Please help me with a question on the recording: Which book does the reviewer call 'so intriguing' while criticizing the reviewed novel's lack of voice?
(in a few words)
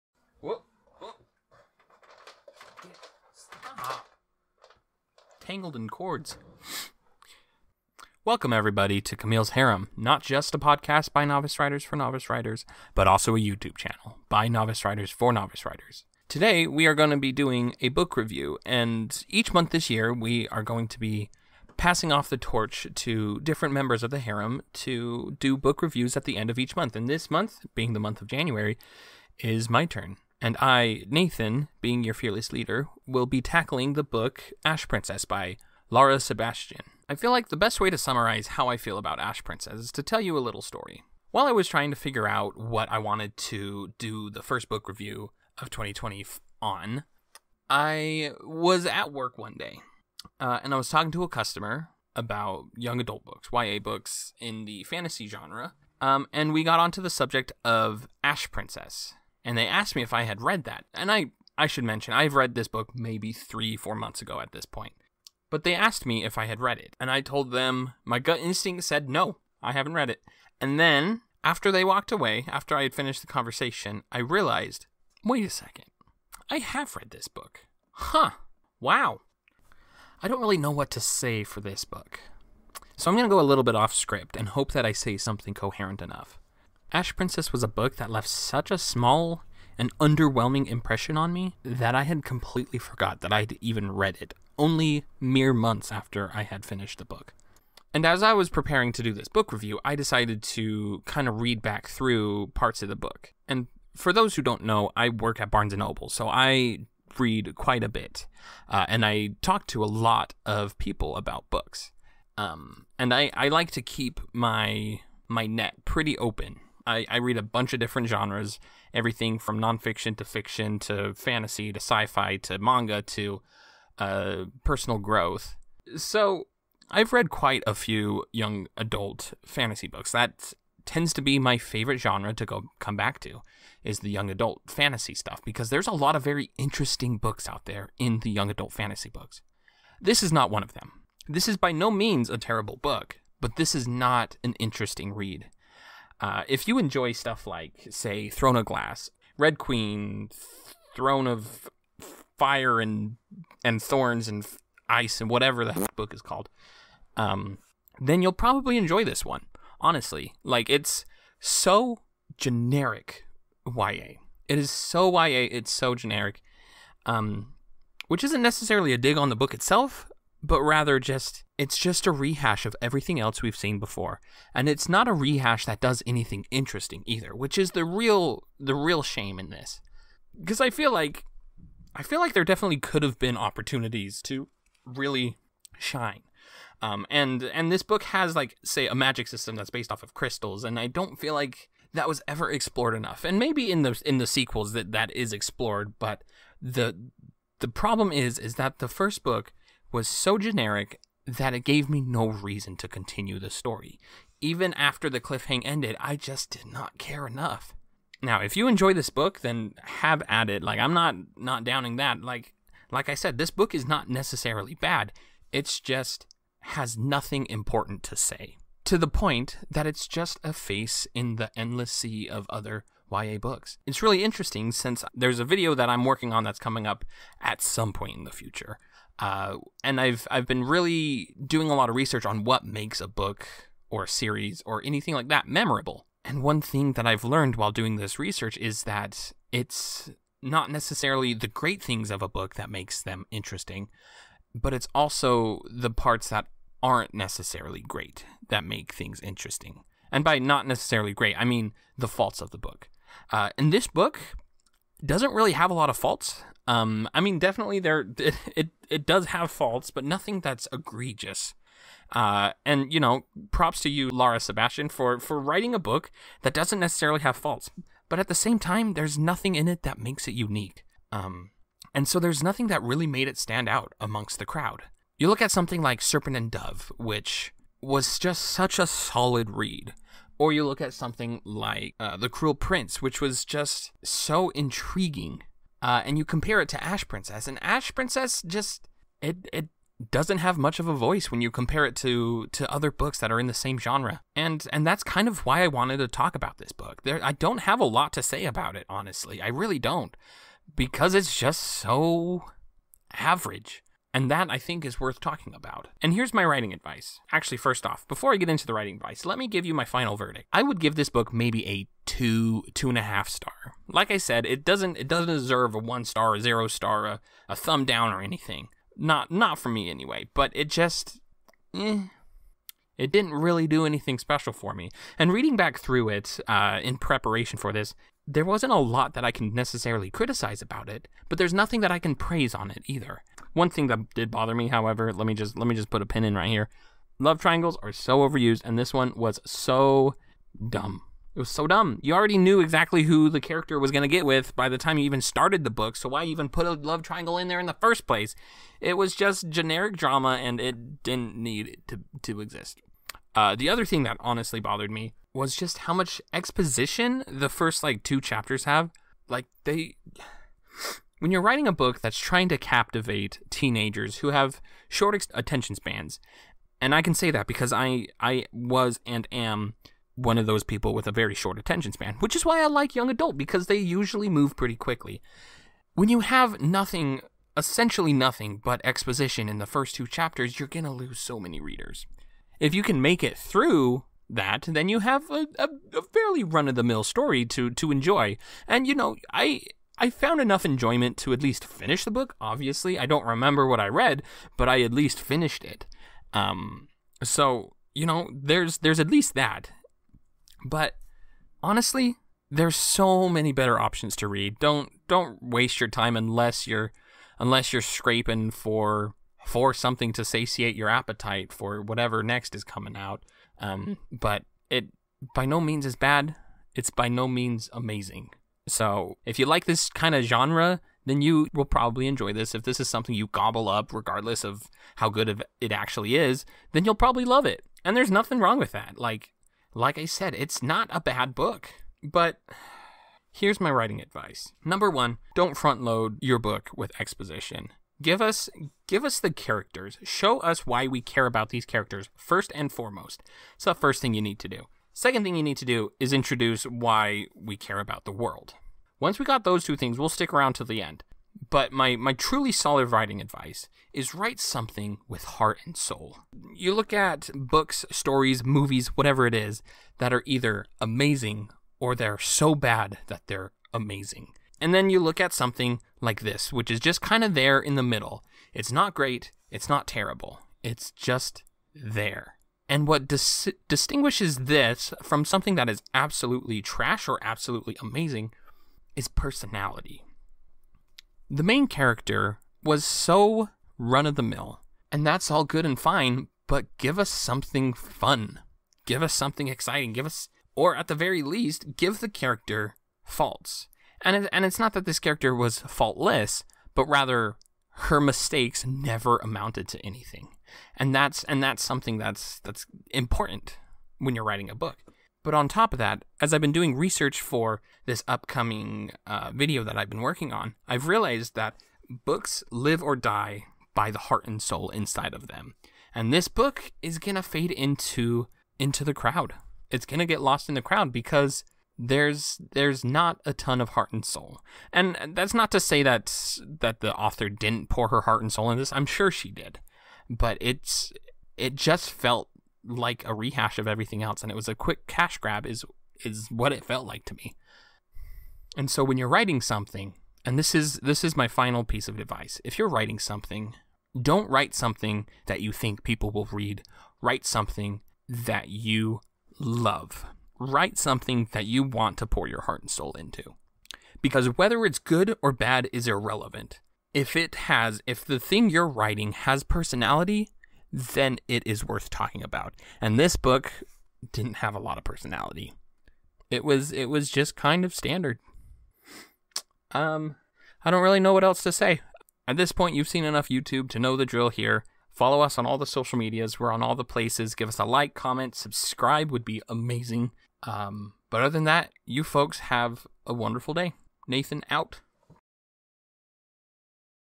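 The Cruel Prince.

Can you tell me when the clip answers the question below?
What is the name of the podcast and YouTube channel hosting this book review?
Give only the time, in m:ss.
0:09.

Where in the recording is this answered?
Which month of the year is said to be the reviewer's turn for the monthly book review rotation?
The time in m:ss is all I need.
0:28.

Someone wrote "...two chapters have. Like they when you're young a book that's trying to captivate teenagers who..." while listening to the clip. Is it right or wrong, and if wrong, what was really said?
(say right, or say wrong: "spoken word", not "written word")
wrong: "writing", not "young".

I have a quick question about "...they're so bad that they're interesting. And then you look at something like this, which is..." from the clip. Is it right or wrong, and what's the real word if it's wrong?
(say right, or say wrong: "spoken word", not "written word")
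wrong: "amazing", not "interesting".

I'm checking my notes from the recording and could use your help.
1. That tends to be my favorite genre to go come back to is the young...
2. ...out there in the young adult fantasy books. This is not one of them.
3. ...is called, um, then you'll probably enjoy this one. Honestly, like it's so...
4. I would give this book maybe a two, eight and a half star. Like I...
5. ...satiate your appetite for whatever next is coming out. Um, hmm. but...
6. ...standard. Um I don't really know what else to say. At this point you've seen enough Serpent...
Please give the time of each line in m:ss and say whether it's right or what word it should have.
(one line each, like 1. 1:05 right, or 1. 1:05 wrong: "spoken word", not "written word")
1. 2:10 right
2. 2:17 right
3. 2:36 right
4. 5:10 wrong: "two", not "eight"
5. 6:50 right
6. 9:27 wrong: "YouTube", not "Serpent".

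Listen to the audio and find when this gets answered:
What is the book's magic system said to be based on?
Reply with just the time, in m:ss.
3:10.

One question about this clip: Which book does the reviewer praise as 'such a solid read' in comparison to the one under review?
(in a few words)
Serpent and Dove.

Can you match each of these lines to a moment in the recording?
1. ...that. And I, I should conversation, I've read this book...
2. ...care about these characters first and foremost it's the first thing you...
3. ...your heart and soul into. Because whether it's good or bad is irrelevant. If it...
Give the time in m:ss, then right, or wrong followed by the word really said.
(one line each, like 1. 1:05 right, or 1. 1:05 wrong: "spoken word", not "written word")
1. 1:00 wrong: "mention", not "conversation"
2. 7:21 right
3. 9:12 right.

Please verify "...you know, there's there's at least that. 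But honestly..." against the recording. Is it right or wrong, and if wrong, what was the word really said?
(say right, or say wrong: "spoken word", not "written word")
right.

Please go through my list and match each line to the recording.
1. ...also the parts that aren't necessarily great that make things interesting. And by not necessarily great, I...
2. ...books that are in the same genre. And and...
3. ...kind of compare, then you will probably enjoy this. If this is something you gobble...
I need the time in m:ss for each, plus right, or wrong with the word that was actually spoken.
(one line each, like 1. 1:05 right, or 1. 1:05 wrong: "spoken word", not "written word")
1. 4:04 right
2. 4:52 right
3. 6:59 wrong: "genre", not "compare".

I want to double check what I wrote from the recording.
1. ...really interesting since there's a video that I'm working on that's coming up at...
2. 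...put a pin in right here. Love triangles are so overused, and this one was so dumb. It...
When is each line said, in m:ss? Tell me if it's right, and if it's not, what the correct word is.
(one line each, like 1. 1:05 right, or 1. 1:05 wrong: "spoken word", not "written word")
1. 3:44 right
2. 5:35 right.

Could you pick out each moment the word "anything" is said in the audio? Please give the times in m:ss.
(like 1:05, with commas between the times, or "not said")
2:56, 3:54, 5:18, 5:23, 8:19.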